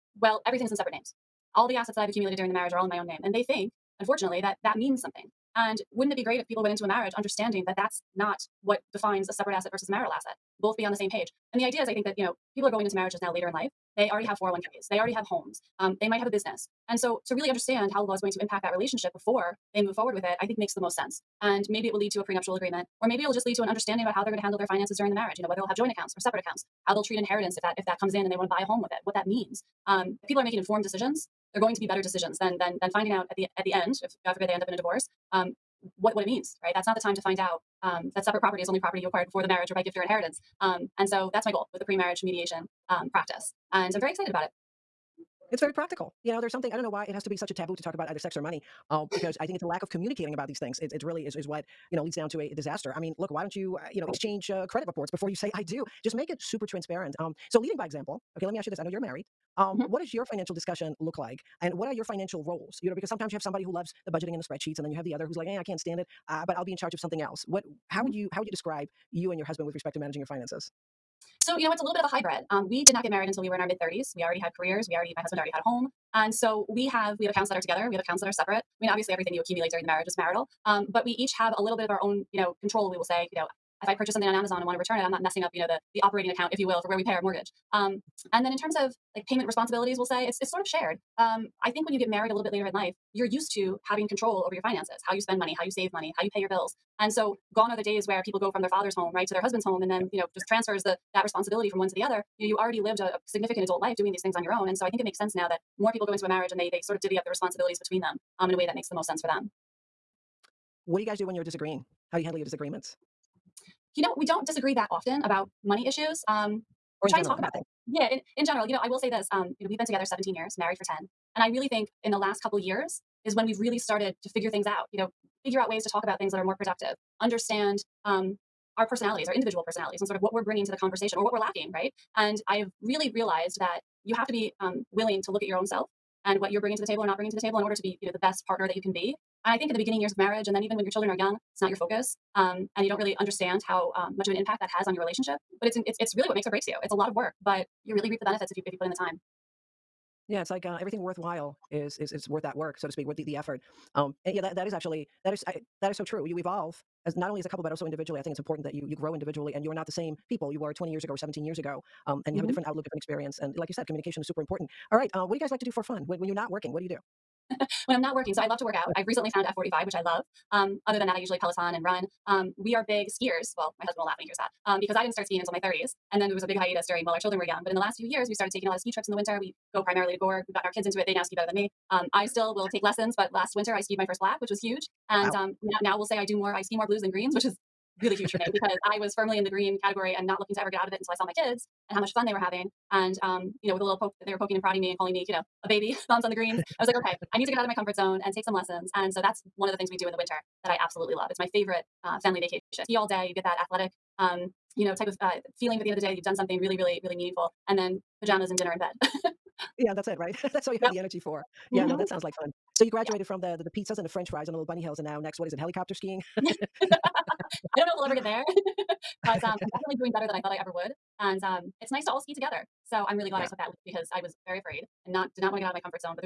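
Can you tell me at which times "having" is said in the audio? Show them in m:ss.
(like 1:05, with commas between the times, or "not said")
1:33, 3:12.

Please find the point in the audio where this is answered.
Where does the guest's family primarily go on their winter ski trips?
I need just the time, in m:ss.
3:00.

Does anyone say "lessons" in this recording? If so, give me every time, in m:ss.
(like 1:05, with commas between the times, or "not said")
3:02, 3:18.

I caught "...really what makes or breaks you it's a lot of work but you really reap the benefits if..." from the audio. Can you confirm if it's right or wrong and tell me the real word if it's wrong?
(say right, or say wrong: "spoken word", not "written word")
right.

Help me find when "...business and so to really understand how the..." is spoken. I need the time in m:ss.
0:16.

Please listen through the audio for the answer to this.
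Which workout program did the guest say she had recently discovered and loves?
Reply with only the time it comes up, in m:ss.
2:49.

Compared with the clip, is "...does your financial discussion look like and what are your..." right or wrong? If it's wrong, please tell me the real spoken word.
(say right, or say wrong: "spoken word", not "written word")
right.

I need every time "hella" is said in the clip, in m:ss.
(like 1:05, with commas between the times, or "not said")
not said.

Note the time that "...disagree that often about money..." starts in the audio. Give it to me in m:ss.
1:54.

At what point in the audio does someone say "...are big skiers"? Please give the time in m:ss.
2:52.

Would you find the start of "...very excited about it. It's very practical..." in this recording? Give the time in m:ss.
0:44.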